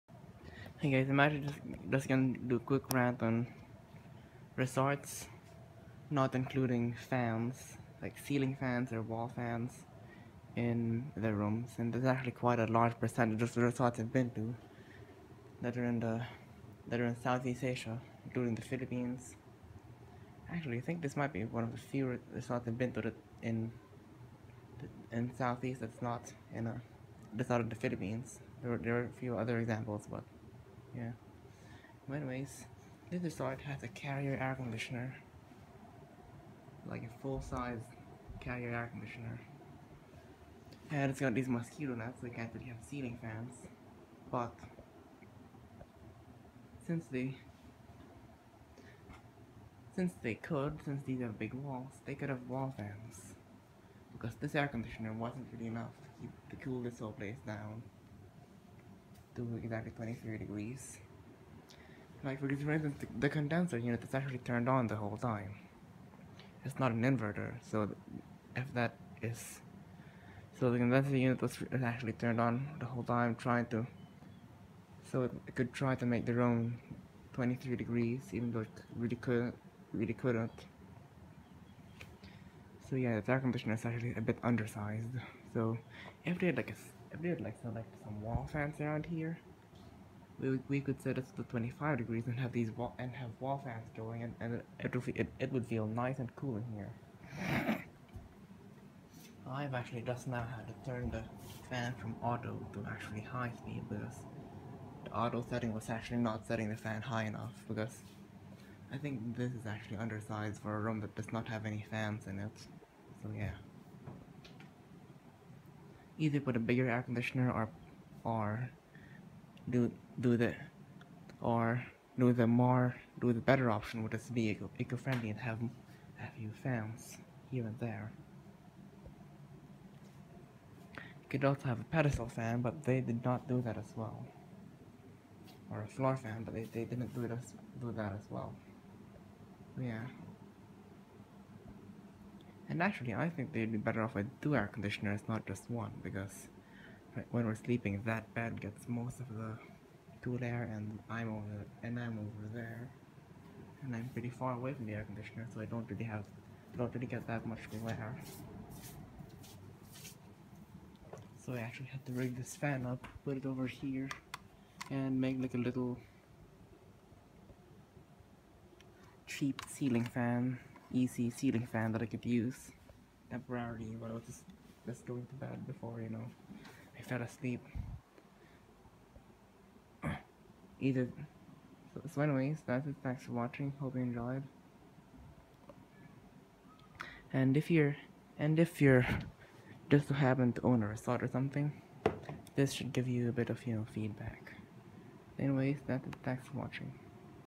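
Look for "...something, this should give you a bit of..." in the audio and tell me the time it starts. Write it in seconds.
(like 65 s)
191 s.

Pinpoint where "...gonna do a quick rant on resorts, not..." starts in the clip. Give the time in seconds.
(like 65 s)
2 s.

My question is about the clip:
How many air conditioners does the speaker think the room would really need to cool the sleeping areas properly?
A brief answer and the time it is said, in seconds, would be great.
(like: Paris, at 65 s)
2, at 144 s.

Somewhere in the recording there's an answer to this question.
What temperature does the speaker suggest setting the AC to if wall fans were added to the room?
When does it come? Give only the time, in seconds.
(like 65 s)
91 s.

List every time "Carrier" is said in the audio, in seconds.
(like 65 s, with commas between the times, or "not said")
33 s, 38 s.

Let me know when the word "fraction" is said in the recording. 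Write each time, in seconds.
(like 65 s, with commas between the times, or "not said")
not said.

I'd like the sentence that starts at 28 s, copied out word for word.
There are there are a few other examples, but yeah.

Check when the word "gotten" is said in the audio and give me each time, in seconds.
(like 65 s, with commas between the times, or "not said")
not said.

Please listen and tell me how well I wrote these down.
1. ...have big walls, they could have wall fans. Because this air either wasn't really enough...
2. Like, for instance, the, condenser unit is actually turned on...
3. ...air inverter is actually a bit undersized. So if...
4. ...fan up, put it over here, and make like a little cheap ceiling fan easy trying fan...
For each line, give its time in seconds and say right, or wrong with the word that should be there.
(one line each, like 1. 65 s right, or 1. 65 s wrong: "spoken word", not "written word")
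1. 51 s wrong: "conditioner", not "either"
2. 62 s right
3. 83 s wrong: "conditioner", not "inverter"
4. 162 s wrong: "ceiling", not "trying".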